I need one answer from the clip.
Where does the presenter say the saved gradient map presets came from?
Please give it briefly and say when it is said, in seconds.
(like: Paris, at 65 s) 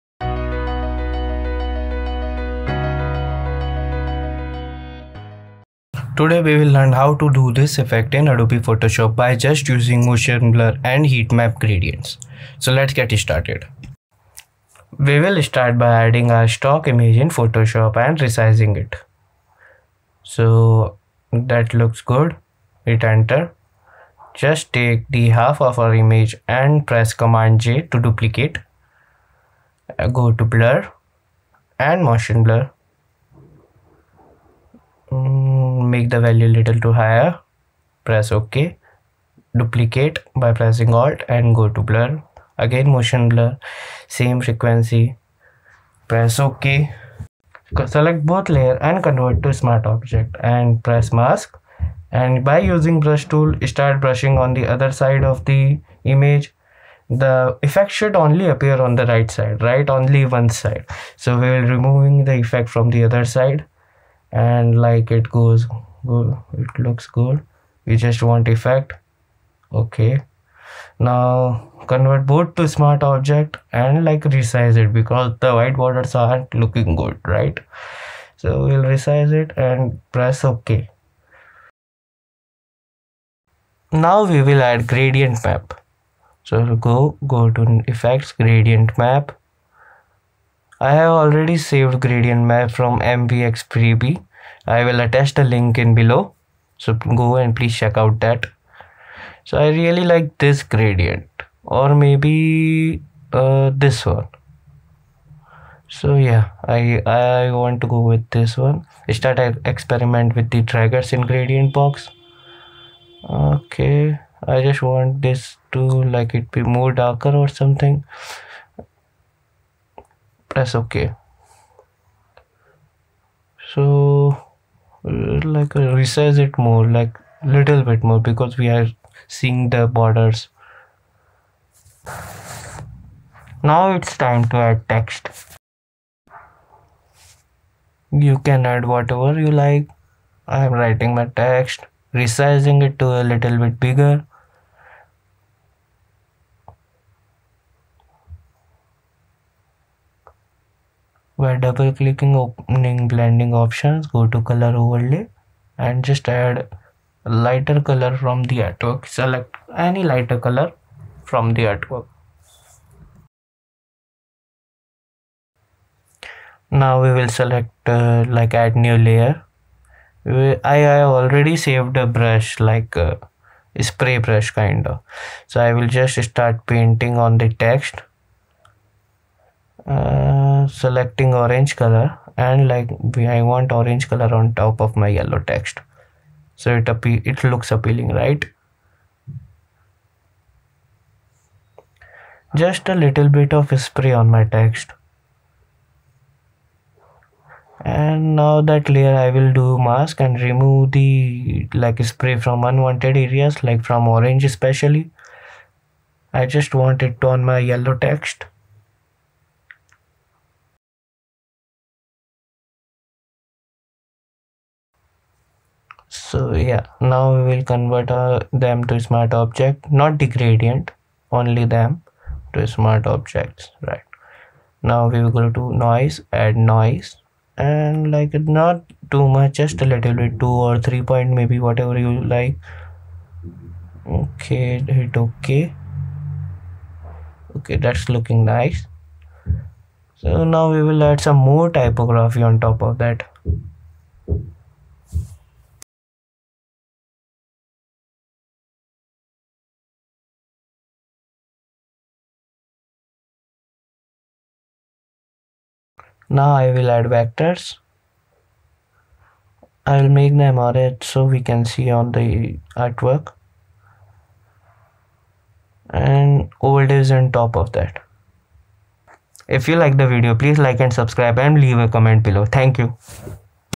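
MVX freebie, at 93 s.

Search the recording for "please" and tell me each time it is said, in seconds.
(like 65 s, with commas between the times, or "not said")
97 s, 270 s.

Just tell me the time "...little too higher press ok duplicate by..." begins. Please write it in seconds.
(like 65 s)
36 s.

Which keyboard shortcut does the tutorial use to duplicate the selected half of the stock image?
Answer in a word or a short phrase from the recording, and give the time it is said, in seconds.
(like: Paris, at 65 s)
Command J, at 27 s.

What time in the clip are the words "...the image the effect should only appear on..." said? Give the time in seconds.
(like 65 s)
55 s.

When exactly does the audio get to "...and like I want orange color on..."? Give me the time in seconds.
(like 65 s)
182 s.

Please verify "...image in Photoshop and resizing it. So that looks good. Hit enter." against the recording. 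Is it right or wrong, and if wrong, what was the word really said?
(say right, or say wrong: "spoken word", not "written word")
right.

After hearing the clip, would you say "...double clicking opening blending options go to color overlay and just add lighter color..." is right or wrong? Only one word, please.
right.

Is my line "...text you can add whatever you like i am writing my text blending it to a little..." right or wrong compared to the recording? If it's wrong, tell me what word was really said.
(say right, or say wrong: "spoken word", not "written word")
wrong: "resizing", not "blending".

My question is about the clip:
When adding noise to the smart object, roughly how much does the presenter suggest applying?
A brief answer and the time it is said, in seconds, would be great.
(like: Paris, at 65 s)
2 or 3 point, at 230 s.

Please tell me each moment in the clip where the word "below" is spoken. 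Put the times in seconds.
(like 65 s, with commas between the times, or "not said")
95 s, 272 s.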